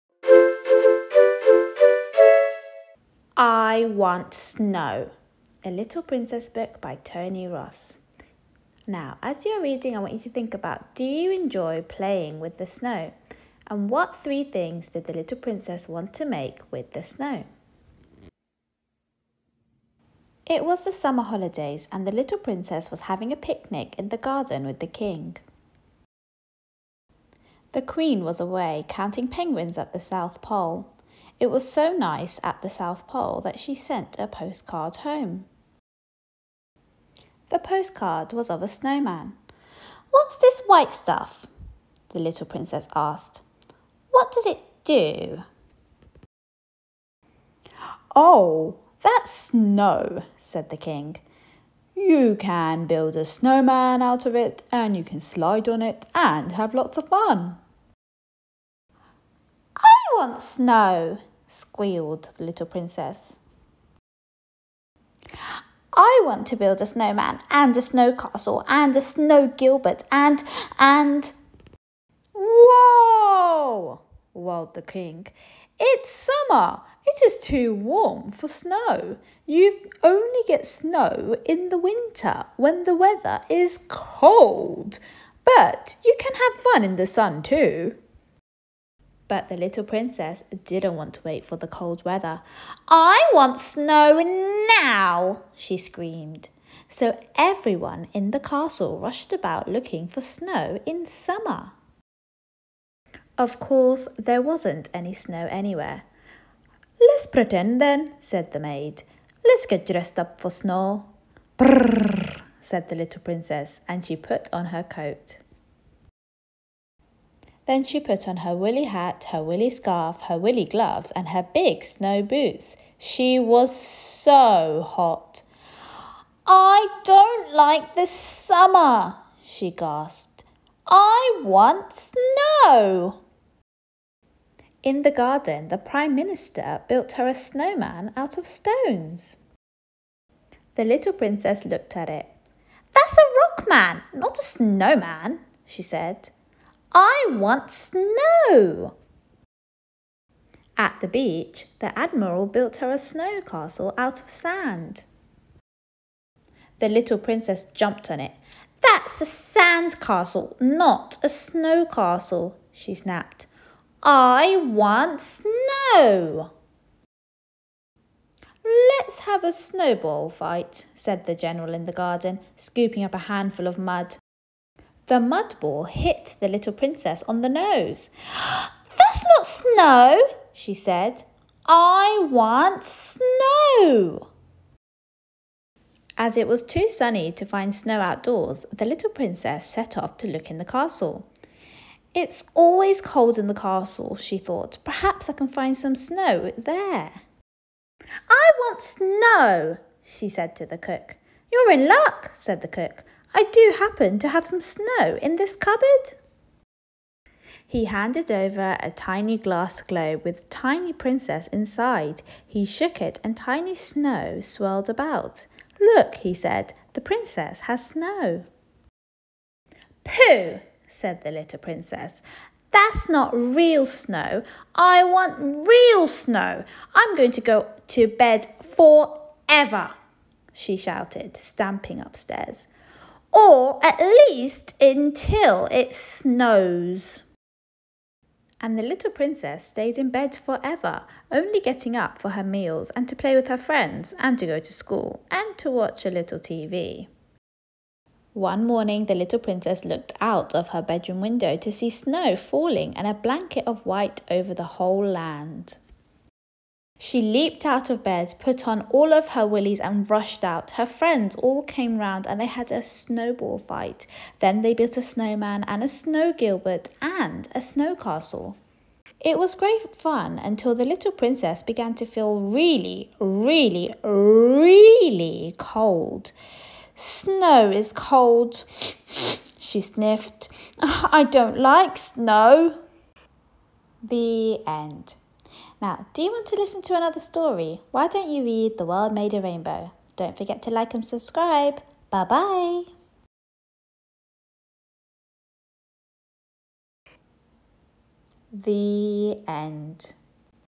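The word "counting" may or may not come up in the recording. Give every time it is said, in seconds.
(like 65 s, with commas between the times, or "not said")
28 s.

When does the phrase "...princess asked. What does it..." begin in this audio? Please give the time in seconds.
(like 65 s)
42 s.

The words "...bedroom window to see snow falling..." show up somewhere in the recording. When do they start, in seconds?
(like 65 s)
250 s.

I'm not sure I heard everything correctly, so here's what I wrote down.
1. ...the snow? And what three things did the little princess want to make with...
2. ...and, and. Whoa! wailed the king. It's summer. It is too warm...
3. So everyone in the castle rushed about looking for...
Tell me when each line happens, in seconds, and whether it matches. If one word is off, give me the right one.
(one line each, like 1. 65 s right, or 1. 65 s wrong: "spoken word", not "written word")
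1. 12 s right
2. 70 s right
3. 96 s right.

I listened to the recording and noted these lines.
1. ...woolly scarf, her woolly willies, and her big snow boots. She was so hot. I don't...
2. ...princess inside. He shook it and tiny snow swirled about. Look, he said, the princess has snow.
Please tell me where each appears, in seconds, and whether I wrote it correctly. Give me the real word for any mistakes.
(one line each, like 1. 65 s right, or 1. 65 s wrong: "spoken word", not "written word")
1. 119 s wrong: "gloves", not "willies"
2. 210 s right.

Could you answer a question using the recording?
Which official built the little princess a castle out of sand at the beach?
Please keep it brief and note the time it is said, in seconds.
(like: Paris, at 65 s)
The Admiral, at 151 s.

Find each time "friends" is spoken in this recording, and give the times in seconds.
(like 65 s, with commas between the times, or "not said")
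243 s, 260 s.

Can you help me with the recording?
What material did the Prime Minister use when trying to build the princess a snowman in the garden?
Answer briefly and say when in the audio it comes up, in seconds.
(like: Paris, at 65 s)
Stones, at 138 s.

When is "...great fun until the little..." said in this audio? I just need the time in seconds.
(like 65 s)
269 s.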